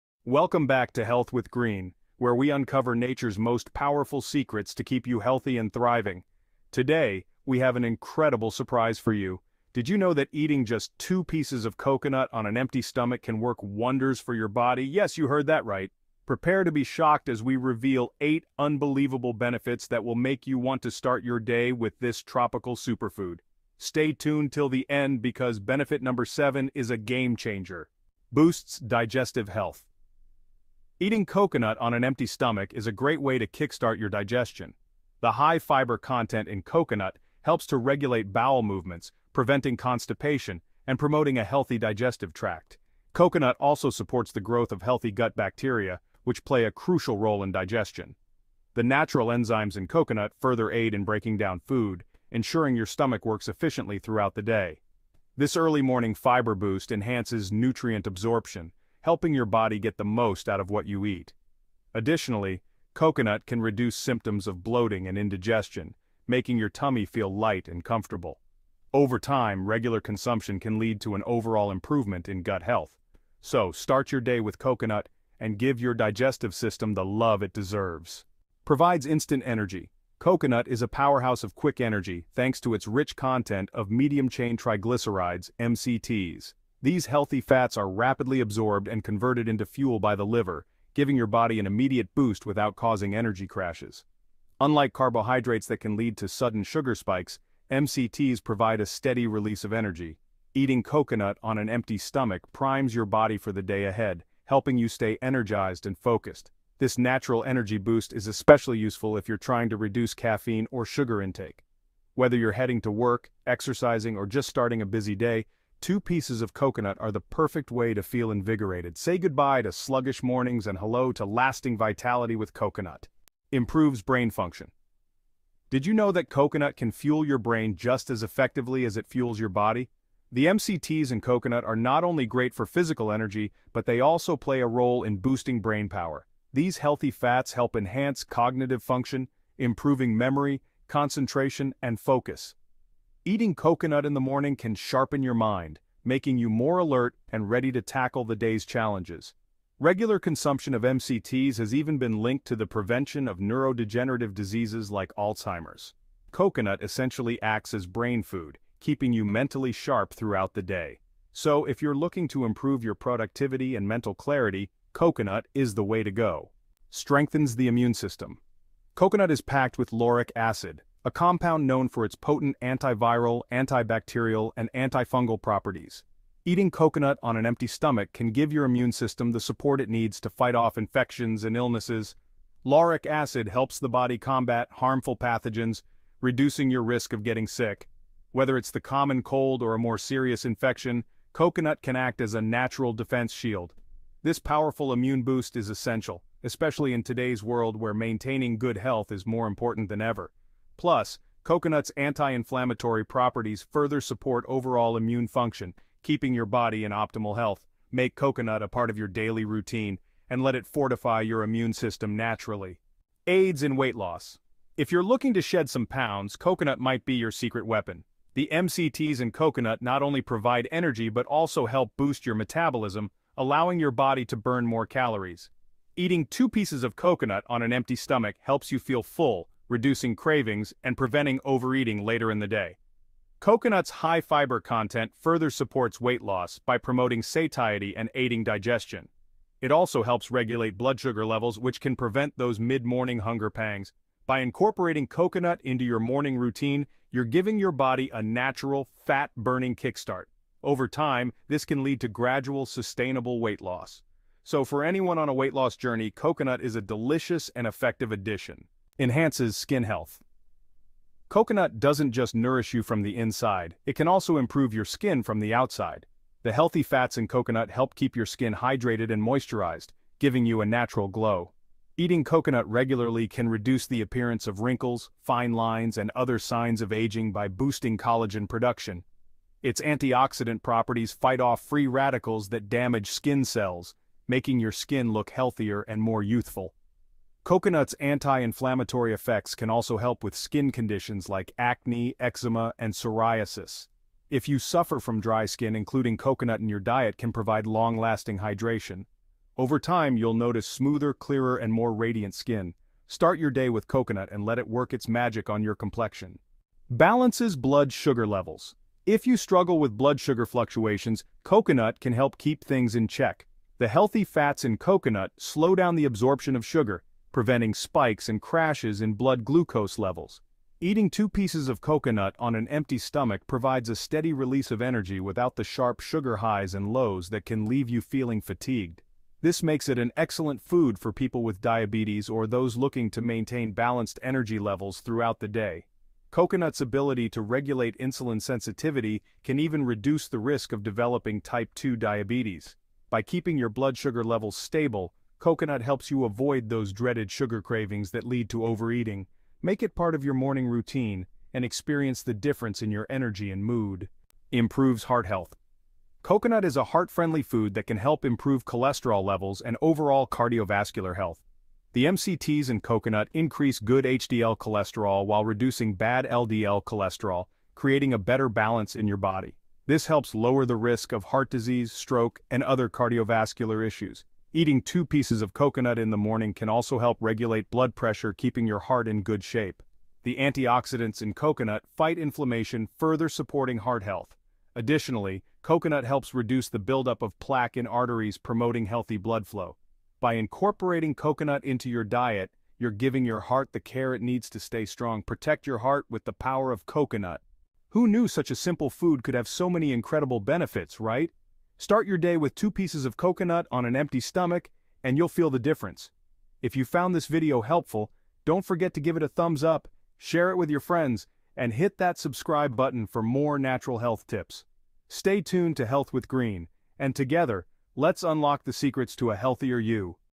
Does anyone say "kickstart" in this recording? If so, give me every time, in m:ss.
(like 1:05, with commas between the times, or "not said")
0:33, 4:09.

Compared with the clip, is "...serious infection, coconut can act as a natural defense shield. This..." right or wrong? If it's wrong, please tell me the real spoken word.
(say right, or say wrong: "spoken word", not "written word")
right.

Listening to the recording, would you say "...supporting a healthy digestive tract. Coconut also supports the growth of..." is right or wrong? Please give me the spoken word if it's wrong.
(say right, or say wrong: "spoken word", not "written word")
wrong: "promoting", not "supporting".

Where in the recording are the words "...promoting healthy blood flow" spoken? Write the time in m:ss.
6:28.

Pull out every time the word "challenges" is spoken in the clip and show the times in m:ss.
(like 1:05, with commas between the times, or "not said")
2:28.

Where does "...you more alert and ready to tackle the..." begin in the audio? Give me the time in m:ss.
2:26.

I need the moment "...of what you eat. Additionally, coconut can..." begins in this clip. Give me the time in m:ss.
1:00.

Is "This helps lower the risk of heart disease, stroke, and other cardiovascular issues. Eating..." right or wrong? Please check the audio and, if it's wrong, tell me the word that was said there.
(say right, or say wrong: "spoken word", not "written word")
right.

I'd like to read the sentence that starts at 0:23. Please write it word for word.
Stay tuned till the end because benefit number seven is a game changer.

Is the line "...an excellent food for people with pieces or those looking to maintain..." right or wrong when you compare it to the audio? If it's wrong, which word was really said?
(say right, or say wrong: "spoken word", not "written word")
wrong: "diabetes", not "pieces".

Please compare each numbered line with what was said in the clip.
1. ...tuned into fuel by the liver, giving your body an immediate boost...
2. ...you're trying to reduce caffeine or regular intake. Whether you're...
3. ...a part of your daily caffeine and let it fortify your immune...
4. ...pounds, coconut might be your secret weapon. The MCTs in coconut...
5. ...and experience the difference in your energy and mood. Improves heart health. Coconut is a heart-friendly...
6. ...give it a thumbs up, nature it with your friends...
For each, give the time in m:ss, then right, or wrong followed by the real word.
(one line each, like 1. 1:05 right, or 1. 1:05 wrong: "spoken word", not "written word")
1. 1:29 wrong: "converted", not "tuned"
2. 1:49 wrong: "sugar", not "regular"
3. 3:28 wrong: "routine", not "caffeine"
4. 3:35 right
5. 5:51 right
6. 6:49 wrong: "share", not "nature".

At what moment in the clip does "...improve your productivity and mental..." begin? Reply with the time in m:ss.
2:42.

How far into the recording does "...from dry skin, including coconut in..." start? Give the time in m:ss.
4:54.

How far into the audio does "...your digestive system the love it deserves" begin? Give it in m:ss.
1:15.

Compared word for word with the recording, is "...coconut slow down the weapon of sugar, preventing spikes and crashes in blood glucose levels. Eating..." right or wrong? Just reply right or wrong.
wrong.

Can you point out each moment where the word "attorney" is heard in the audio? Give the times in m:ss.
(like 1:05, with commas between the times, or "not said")
not said.